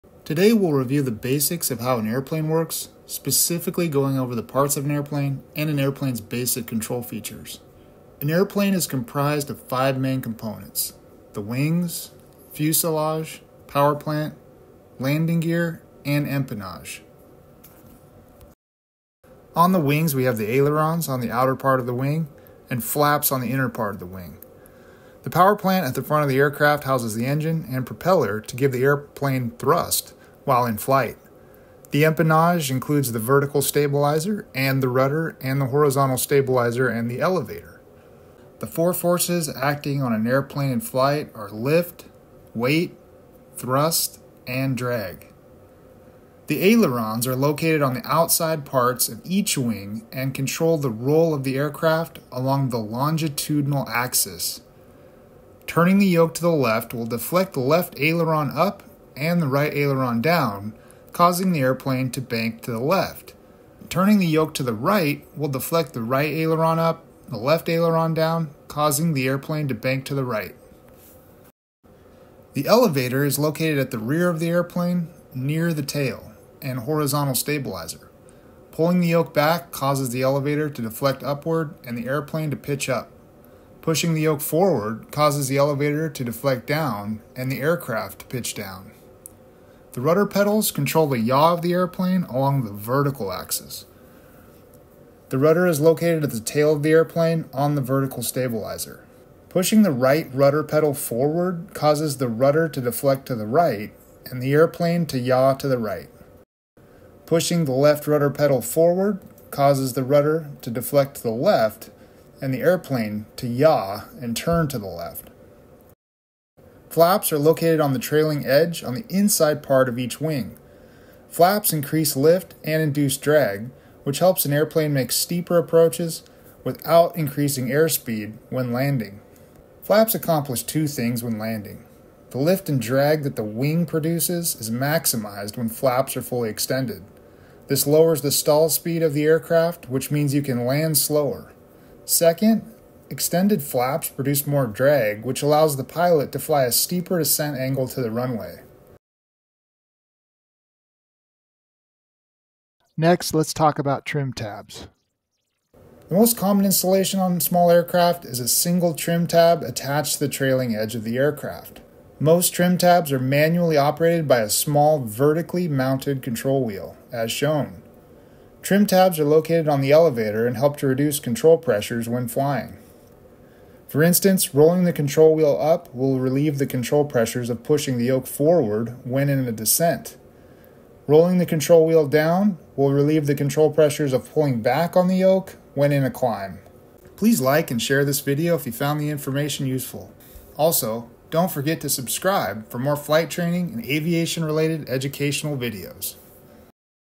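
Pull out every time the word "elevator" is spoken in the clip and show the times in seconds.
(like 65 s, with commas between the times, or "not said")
37 s, 72 s, 80 s, 85 s, 169 s.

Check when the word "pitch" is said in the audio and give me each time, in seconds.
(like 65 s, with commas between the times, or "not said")
82 s, 88 s.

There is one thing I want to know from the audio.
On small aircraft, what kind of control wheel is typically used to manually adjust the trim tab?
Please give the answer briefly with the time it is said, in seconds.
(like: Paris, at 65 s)
vertically mounted control wheel, at 165 s.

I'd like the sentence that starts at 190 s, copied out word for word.
Also, don't forget to subscribe for more flight training and aviation related educational videos.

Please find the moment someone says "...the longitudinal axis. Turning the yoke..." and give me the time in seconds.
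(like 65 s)
52 s.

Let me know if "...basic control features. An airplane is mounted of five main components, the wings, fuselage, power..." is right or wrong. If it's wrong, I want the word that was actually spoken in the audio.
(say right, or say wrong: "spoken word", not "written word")
wrong: "comprised", not "mounted".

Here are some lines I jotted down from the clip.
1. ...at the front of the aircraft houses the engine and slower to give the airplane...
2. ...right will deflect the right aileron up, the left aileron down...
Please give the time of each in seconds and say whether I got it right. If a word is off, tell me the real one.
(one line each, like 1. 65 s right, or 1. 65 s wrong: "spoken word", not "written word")
1. 25 s wrong: "propeller", not "slower"
2. 64 s right.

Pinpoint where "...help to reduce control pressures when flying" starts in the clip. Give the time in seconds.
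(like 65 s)
170 s.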